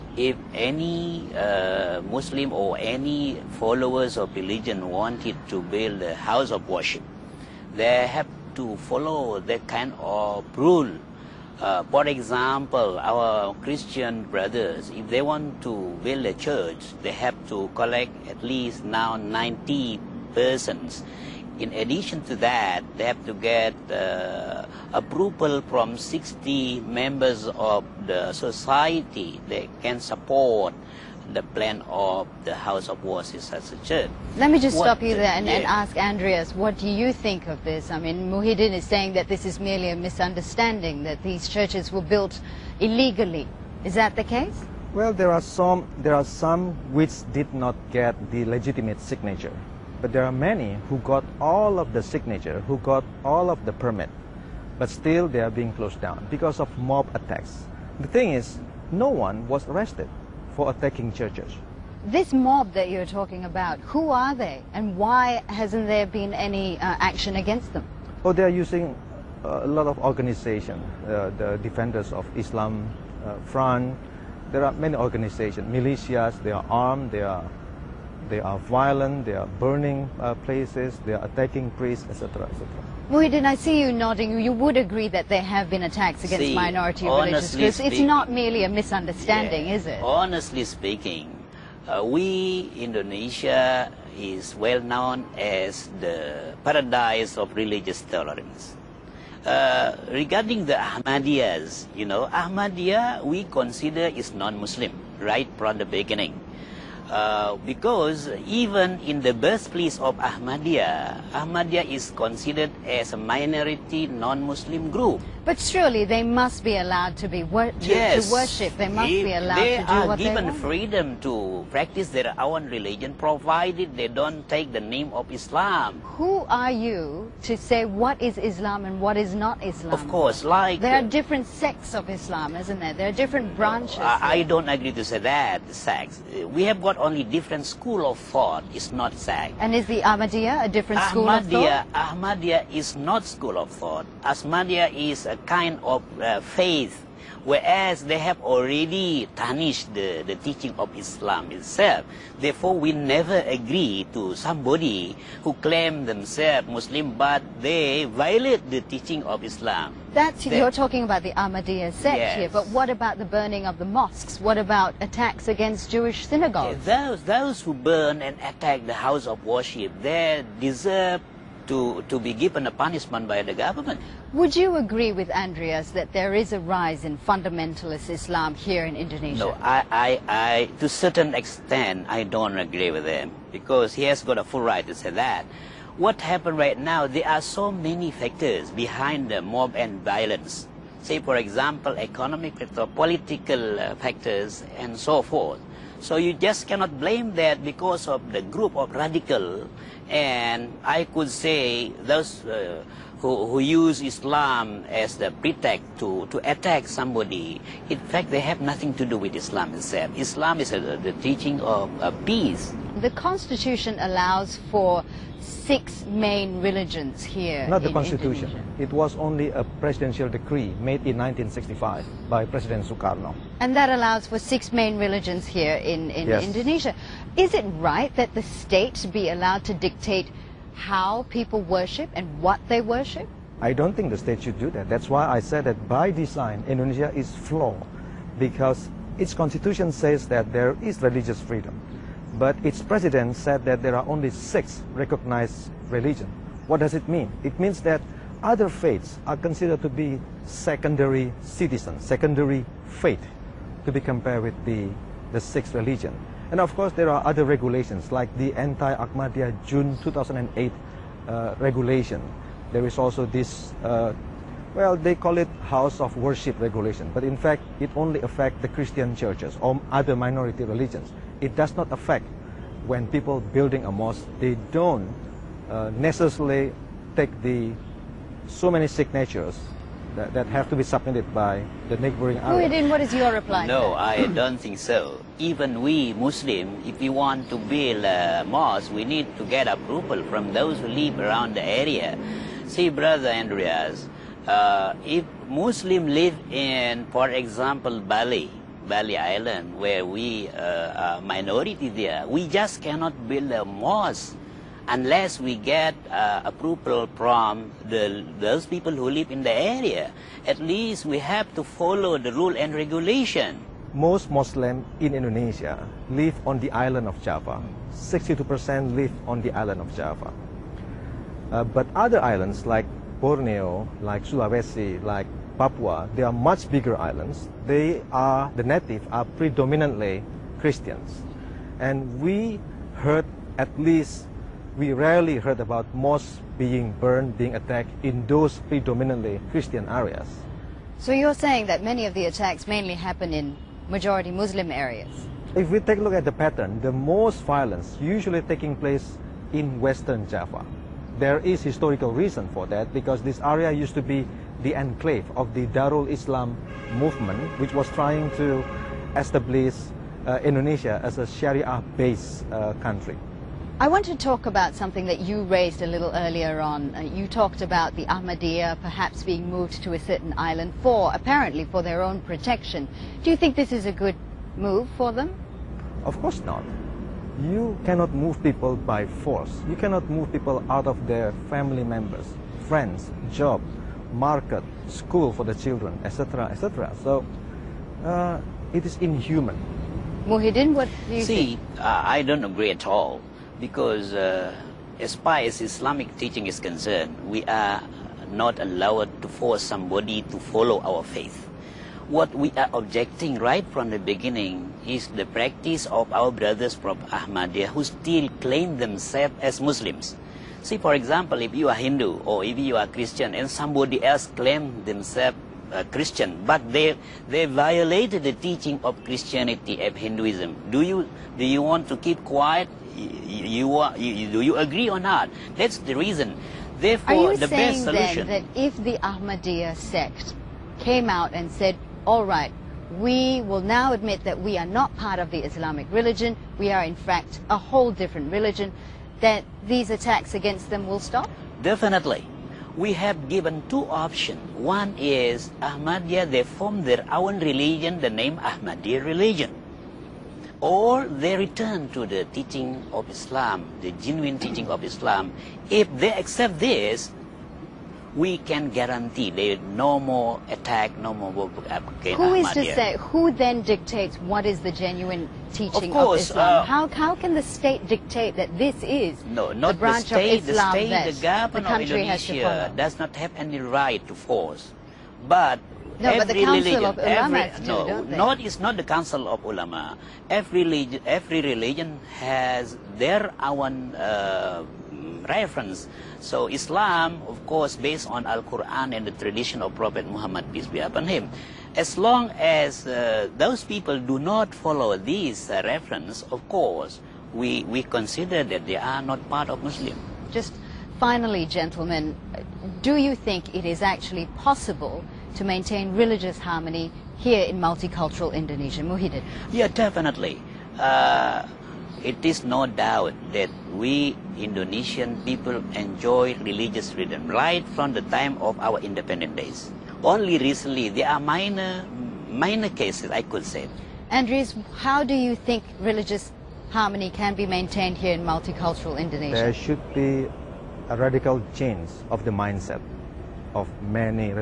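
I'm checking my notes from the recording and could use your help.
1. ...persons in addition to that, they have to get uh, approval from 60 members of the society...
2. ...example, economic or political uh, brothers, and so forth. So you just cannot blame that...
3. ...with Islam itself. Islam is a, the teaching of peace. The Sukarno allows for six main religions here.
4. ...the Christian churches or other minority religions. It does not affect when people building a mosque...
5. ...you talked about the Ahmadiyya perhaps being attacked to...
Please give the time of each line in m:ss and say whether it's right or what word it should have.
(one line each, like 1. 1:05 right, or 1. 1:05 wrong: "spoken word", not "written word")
1. 0:20 right
2. 3:11 wrong: "factors", not "brothers"
3. 3:29 wrong: "Constitution", not "Sukarno"
4. 4:28 right
5. 6:07 wrong: "moved", not "attacked".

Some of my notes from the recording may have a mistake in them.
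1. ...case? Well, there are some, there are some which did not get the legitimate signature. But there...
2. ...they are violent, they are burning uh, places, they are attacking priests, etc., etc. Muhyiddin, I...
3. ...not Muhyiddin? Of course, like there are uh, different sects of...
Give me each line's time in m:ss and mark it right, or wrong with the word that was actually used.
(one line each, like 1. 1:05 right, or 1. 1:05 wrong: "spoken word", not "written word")
1. 0:44 right
2. 1:18 right
3. 2:09 wrong: "Islam", not "Muhyiddin".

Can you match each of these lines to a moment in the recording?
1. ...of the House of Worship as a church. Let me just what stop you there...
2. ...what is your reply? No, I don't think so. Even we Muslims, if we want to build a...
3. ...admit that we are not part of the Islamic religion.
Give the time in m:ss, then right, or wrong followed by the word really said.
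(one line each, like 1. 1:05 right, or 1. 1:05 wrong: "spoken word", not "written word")
1. 0:31 right
2. 4:42 right
3. 7:13 right.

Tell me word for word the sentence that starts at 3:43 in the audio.
And that allows for six main religions here in, in yes.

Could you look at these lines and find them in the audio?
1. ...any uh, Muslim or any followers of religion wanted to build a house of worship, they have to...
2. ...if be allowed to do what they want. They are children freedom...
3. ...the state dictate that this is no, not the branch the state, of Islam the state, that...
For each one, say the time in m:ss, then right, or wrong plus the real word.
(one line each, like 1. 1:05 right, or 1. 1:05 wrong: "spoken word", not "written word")
1. 0:00 right
2. 1:59 wrong: "given", not "children"
3. 7:47 right.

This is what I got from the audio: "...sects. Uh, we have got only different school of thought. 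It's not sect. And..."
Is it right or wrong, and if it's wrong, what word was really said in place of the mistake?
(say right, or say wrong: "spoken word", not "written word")
right.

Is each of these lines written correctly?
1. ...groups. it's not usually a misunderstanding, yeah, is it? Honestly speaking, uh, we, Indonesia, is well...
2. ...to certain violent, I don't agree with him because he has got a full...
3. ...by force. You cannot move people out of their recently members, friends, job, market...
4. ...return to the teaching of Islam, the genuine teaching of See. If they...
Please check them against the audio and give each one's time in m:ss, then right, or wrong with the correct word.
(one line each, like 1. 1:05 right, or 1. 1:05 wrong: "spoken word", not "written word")
1. 1:27 wrong: "merely", not "usually"
2. 3:00 wrong: "extent", not "violent"
3. 6:18 wrong: "family", not "recently"
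4. 7:31 wrong: "Islam", not "See".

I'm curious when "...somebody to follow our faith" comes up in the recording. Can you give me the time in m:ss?
6:39.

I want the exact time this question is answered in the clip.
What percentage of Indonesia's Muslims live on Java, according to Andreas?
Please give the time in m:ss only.
5:17.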